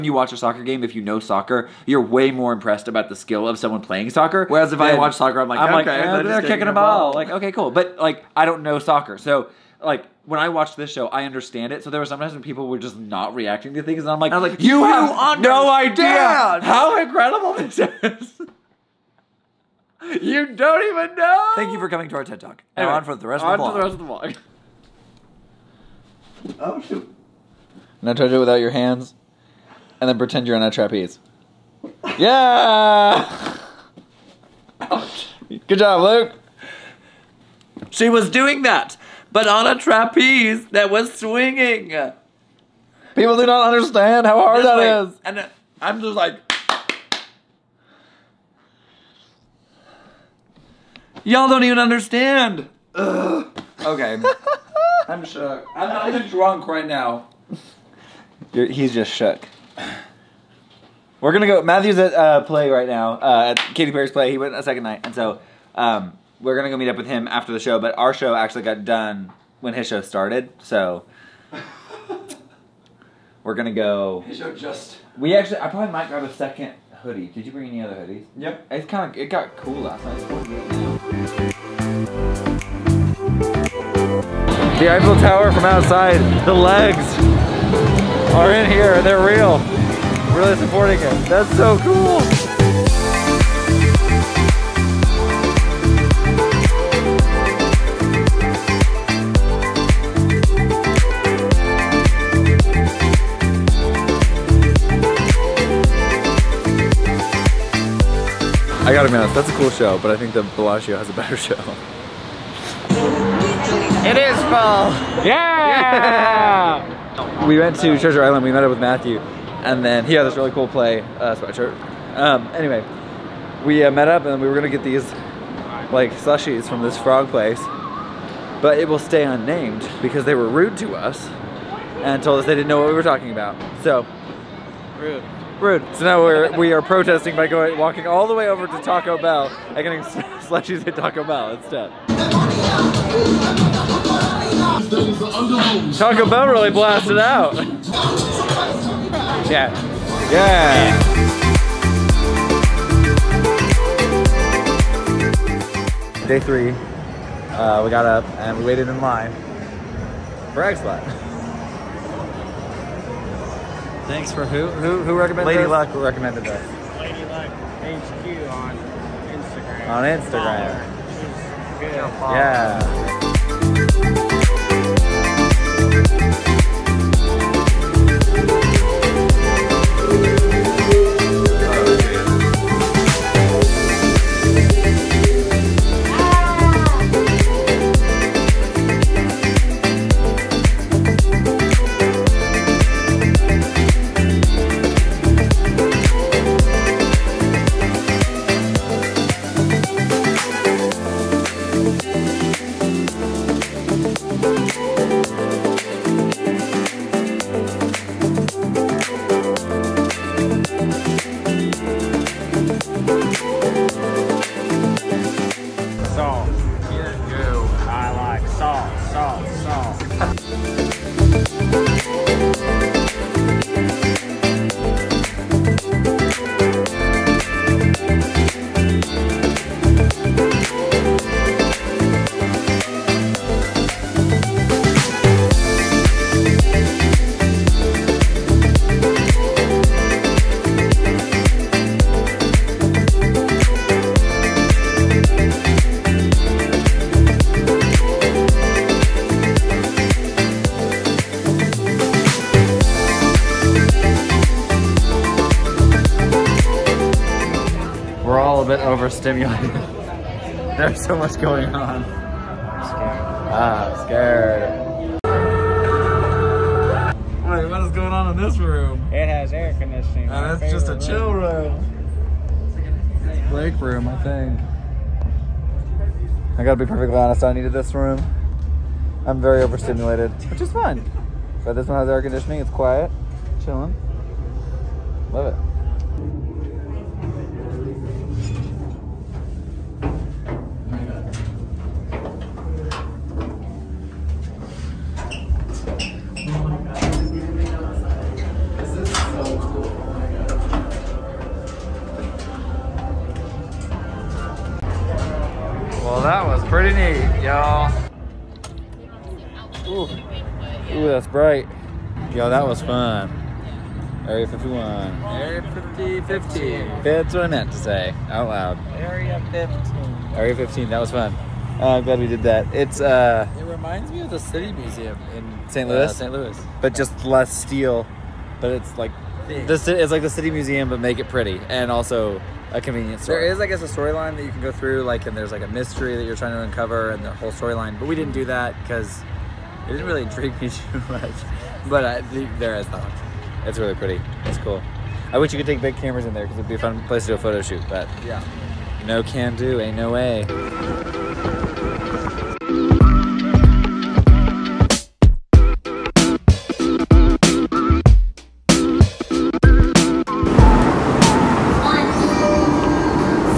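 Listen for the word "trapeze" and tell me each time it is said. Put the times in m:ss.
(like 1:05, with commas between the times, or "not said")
0:30, 0:39.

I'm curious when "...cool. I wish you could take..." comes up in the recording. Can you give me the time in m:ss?
5:44.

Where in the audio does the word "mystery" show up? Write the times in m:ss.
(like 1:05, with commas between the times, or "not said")
5:35.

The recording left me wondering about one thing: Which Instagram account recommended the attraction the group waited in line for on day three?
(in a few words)
Lady Luck HQ.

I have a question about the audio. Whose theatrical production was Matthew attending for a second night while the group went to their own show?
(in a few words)
Katy Perry.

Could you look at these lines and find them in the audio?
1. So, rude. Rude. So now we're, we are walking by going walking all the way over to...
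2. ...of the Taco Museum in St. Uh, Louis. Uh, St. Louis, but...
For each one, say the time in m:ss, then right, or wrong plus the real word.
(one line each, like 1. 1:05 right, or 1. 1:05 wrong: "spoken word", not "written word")
1. 2:13 wrong: "protesting", not "walking"
2. 5:24 wrong: "City", not "Taco".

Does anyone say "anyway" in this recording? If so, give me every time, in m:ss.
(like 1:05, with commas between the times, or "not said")
0:22, 2:02.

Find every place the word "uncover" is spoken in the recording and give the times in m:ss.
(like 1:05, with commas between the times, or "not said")
5:36.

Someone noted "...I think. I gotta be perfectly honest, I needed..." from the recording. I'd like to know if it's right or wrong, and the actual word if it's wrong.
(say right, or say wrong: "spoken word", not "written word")
right.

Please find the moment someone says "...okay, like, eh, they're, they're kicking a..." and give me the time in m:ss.
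0:05.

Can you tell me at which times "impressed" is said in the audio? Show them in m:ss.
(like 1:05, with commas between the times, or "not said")
0:02.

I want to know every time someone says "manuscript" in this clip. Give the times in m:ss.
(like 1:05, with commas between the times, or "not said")
not said.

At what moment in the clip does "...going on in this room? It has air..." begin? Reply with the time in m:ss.
4:27.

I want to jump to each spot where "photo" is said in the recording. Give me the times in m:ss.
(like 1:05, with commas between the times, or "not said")
5:47.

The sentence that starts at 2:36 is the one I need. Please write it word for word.
Day three, uh, we got up and we waited in line for X Lot.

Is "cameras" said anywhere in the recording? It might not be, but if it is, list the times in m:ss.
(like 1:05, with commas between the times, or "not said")
5:45.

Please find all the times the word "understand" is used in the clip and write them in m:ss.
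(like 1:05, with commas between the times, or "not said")
0:11, 0:43, 0:51.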